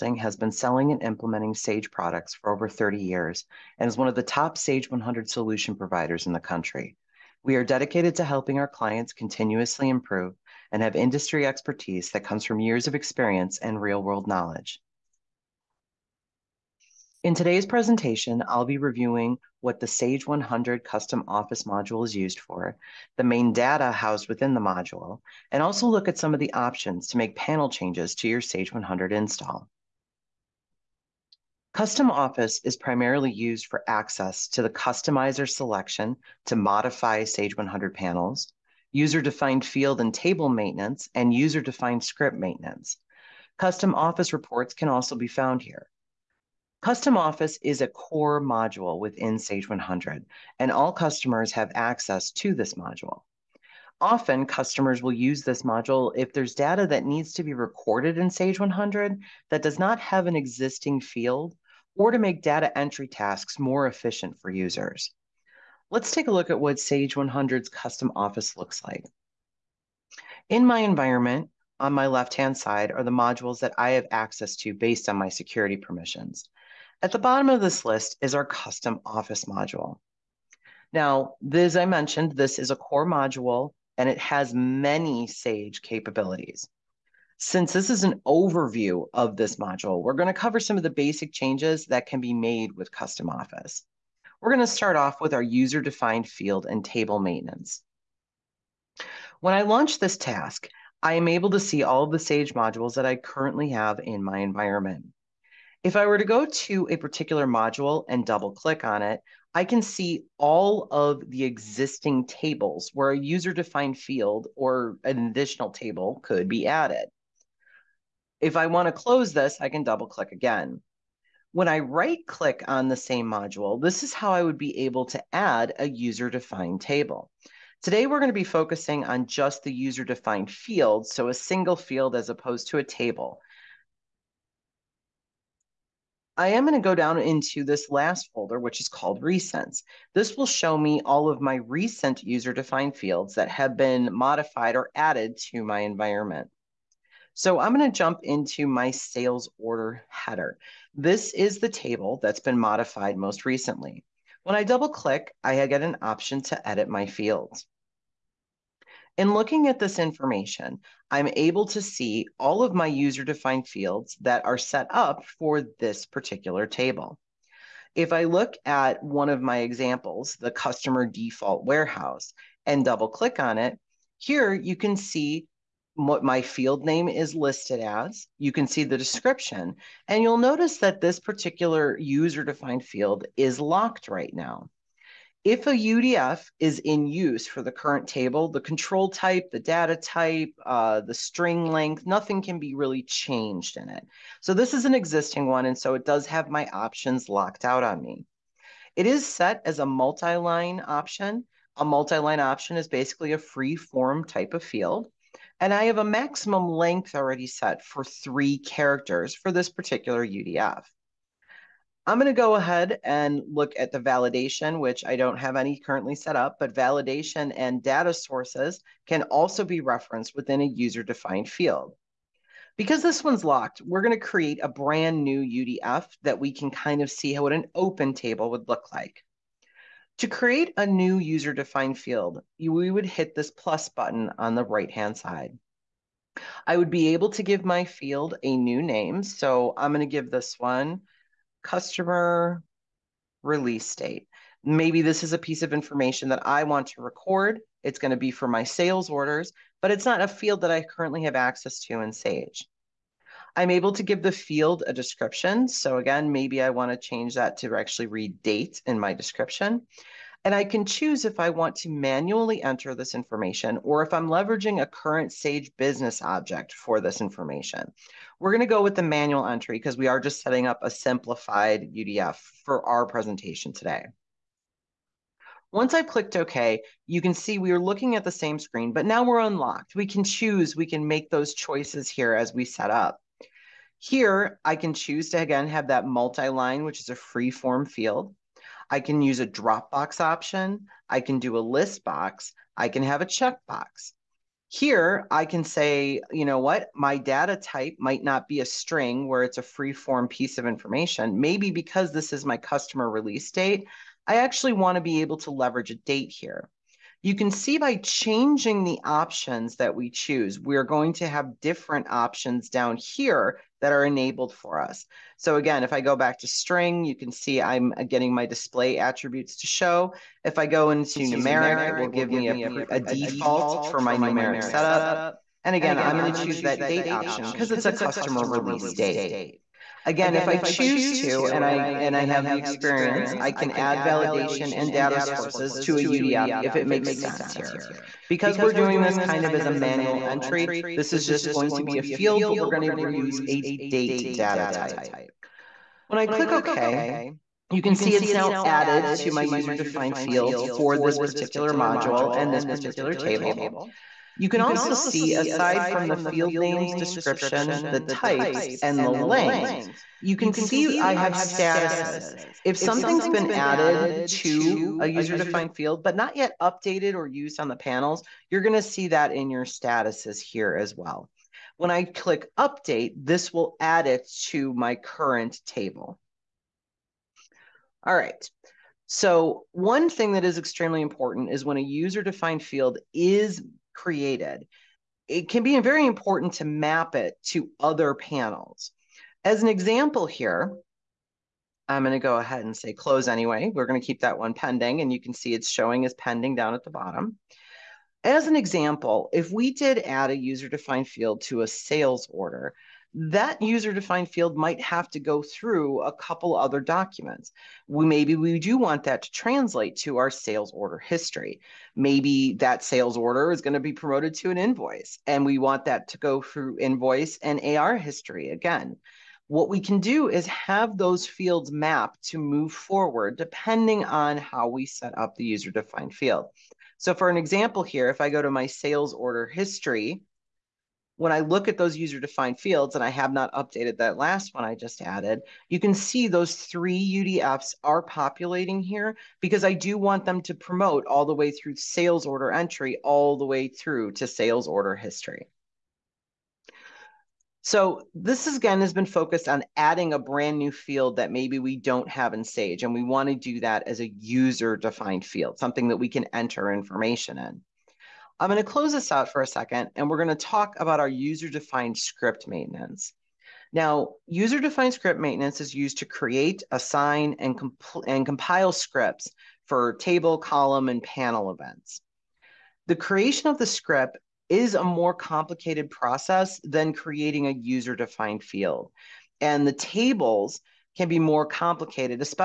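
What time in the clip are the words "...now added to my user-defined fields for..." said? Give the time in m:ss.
5:48.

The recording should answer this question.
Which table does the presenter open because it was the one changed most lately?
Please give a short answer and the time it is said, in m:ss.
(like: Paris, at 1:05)
Sales order header, at 2:28.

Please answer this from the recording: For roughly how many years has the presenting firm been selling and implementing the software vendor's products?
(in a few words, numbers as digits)
Over 30 years.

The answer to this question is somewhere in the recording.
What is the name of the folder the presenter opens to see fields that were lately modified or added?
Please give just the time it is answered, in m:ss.
2:19.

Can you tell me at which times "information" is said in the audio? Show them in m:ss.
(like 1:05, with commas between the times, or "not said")
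2:39, 4:05, 4:23, 4:27, 5:00, 7:36.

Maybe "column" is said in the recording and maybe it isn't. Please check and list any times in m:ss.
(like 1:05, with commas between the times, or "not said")
7:50.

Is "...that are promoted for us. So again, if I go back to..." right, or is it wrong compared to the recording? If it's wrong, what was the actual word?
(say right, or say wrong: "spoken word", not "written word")
wrong: "enabled", not "promoted".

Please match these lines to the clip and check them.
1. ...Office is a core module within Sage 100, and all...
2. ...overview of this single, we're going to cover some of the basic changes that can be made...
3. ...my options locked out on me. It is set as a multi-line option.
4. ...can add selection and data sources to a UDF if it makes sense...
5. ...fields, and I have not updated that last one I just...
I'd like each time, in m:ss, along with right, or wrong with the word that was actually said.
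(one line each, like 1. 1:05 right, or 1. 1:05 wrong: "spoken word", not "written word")
1. 0:47 right
2. 1:28 wrong: "module", not "single"
3. 3:16 right
4. 5:33 wrong: "validation", not "selection"
5. 7:12 right.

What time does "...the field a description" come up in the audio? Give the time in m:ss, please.
4:14.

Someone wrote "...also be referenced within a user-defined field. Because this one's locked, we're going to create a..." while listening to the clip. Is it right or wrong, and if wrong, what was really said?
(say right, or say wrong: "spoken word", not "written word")
right.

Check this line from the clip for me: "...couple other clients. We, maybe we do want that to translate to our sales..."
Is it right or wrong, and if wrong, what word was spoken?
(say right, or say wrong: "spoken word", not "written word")
wrong: "documents", not "clients".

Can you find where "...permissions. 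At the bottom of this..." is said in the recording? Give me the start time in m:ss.
1:15.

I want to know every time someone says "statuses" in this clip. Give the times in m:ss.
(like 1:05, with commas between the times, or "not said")
6:01, 6:09.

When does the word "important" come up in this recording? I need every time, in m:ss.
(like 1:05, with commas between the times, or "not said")
6:21, 6:26.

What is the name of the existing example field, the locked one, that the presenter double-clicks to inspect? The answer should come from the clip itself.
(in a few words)
Customer default warehouse.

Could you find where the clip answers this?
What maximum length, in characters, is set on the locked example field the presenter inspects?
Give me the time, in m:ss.
3:28.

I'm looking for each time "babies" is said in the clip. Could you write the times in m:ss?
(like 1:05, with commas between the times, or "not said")
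not said.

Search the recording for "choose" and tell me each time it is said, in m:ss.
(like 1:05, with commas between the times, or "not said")
4:20, 4:40, 4:44, 5:10, 5:26, 5:30.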